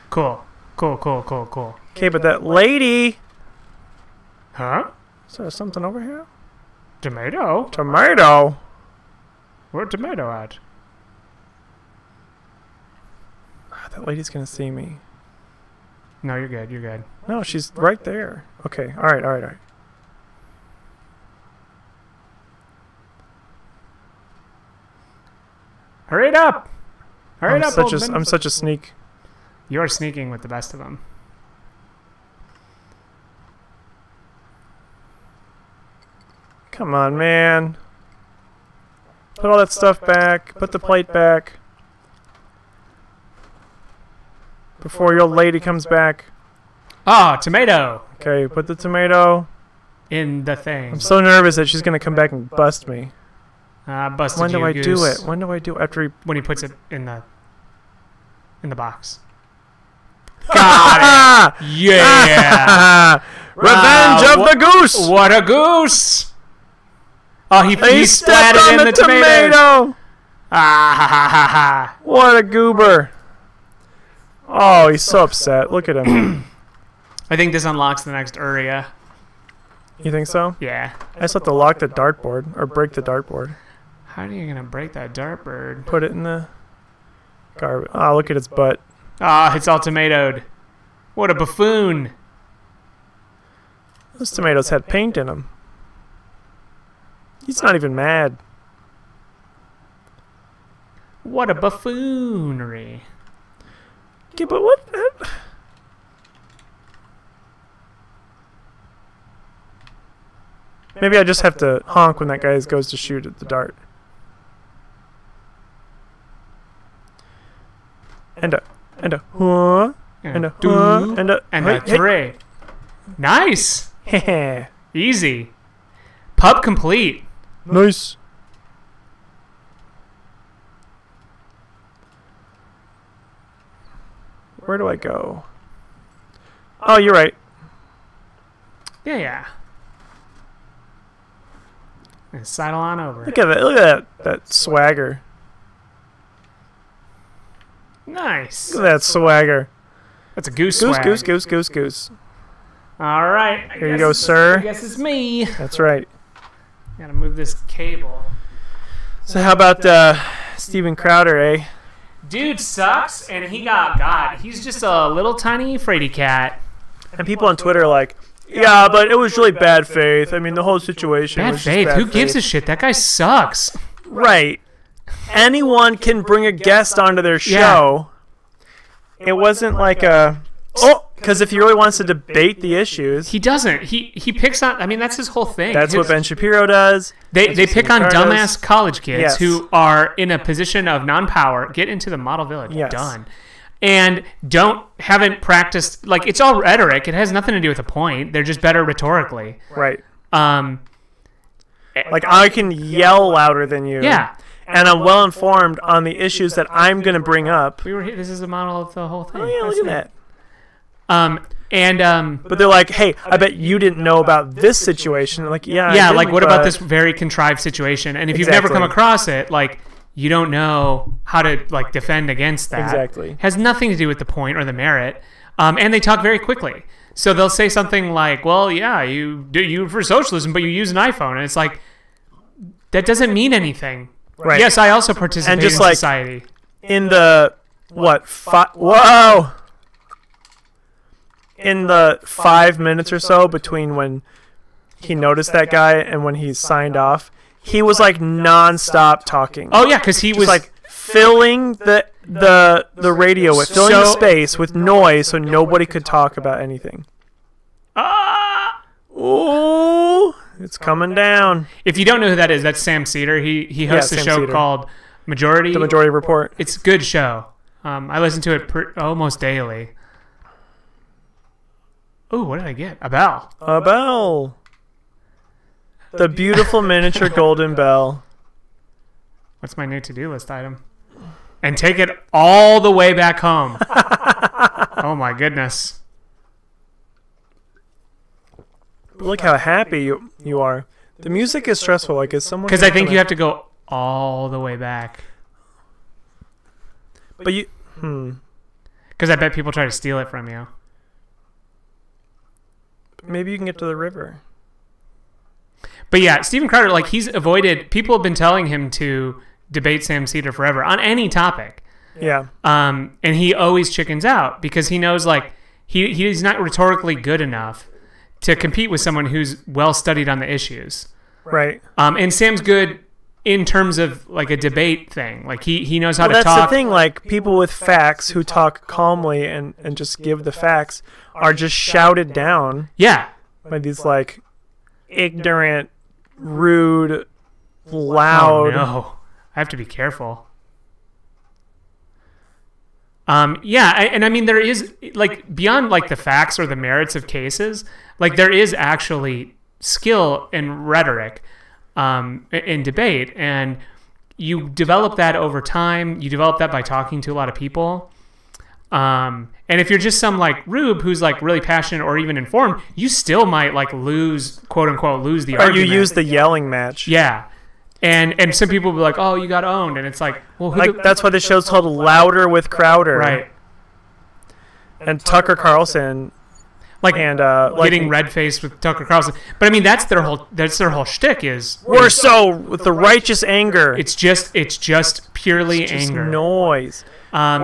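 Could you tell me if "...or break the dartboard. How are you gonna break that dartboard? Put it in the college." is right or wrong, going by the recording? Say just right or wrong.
wrong.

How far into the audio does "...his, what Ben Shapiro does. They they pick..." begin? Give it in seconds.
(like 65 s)
185 s.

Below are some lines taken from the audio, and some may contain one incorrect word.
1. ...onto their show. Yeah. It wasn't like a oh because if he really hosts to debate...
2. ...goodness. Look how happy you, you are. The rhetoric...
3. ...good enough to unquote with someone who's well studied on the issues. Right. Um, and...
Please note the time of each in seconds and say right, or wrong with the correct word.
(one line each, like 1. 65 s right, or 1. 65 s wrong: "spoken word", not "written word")
1. 176 s wrong: "wants", not "hosts"
2. 285 s wrong: "music", not "rhetoric"
3. 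317 s wrong: "compete", not "unquote".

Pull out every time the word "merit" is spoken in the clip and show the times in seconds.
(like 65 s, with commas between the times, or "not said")
224 s, 346 s.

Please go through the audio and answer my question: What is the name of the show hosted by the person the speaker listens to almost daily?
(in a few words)
The Majority Report.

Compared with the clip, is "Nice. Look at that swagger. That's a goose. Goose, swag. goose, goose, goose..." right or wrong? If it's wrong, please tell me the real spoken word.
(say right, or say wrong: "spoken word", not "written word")
right.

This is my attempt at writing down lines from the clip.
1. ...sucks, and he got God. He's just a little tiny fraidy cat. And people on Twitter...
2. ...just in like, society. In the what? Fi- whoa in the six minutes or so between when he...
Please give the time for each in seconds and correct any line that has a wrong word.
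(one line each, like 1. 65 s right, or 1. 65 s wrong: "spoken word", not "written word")
1. 162 s right
2. 235 s wrong: "five", not "six".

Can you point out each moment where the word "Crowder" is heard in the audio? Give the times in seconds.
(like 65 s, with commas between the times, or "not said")
160 s, 306 s, 372 s.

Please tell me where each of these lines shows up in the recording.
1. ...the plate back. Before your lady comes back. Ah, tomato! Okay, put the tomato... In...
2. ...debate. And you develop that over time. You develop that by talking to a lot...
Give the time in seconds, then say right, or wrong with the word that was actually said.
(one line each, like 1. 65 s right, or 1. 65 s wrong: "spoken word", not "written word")
1. 40 s right
2. 352 s right.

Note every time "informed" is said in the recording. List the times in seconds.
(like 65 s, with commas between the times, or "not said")
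205 s, 362 s.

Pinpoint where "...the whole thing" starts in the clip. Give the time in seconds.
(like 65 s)
208 s.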